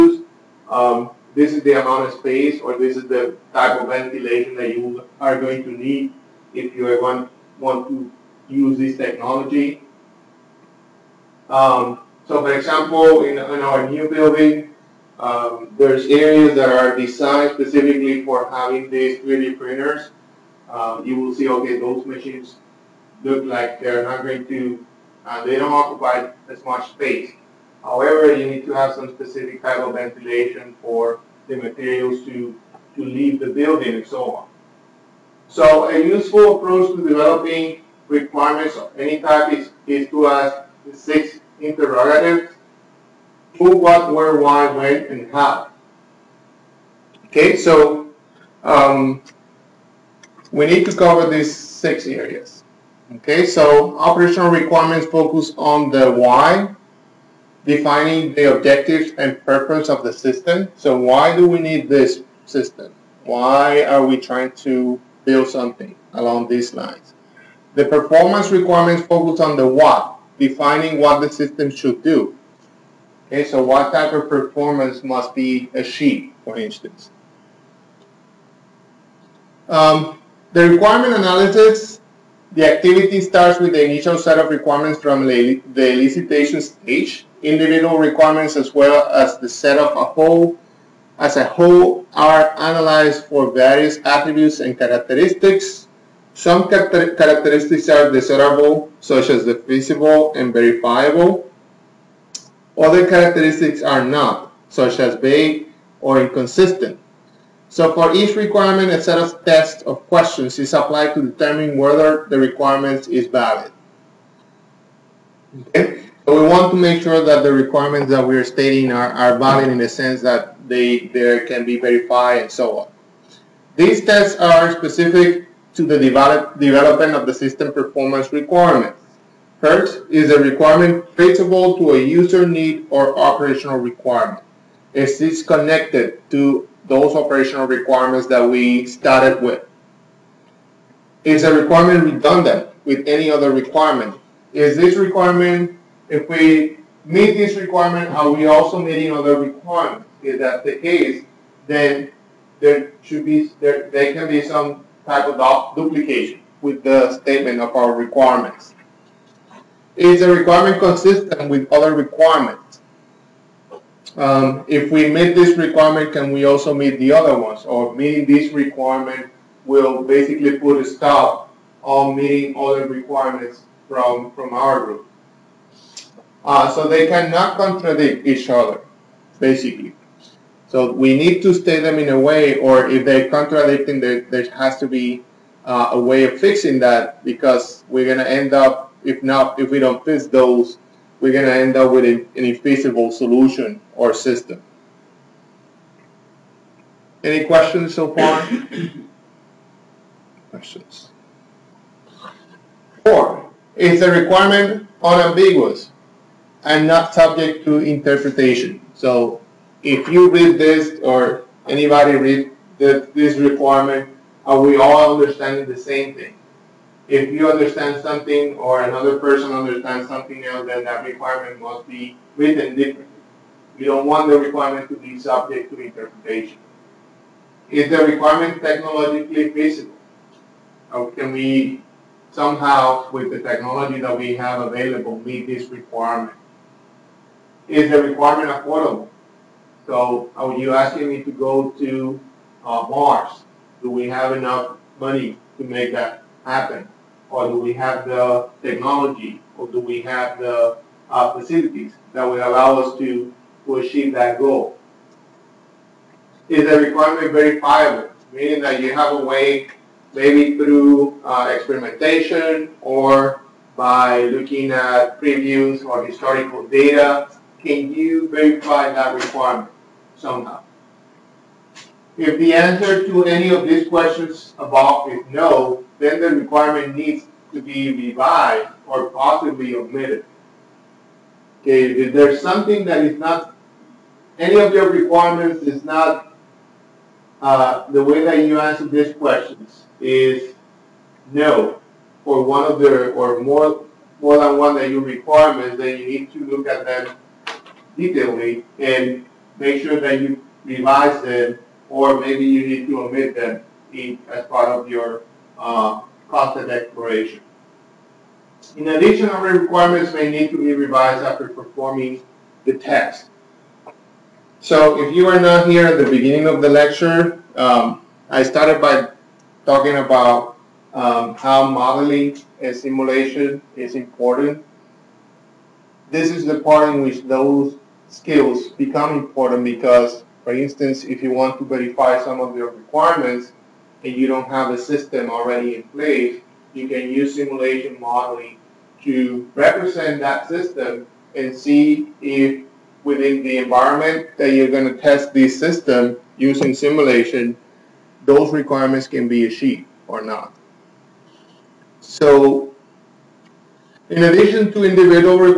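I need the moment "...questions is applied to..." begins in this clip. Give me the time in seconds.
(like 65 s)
110 s.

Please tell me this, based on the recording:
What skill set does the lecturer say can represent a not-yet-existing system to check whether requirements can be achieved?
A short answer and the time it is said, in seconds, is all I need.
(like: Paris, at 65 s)
Simulation modeling, at 337 s.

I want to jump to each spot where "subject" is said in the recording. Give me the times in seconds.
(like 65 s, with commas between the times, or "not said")
207 s, 225 s.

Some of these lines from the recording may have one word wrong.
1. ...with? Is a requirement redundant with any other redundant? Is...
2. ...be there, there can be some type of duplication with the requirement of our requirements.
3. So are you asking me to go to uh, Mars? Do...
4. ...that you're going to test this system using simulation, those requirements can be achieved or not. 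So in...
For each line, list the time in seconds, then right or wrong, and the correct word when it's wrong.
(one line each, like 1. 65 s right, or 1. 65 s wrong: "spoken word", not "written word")
1. 139 s wrong: "requirement", not "redundant"
2. 153 s wrong: "statement", not "requirement"
3. 239 s right
4. 344 s right.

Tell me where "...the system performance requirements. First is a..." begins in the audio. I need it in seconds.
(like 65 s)
127 s.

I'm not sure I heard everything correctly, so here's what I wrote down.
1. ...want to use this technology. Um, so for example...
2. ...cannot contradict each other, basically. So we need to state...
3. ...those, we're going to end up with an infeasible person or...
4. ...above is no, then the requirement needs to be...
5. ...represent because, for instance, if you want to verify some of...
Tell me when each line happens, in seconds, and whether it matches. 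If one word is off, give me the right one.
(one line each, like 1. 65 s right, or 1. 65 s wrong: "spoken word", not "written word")
1. 7 s right
2. 177 s right
3. 190 s wrong: "solution", not "person"
4. 274 s right
5. 329 s wrong: "important", not "represent".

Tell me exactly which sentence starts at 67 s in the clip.
The performance requirements focus on the what, defining what the system should do.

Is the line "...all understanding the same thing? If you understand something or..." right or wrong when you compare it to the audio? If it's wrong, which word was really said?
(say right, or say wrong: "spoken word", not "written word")
right.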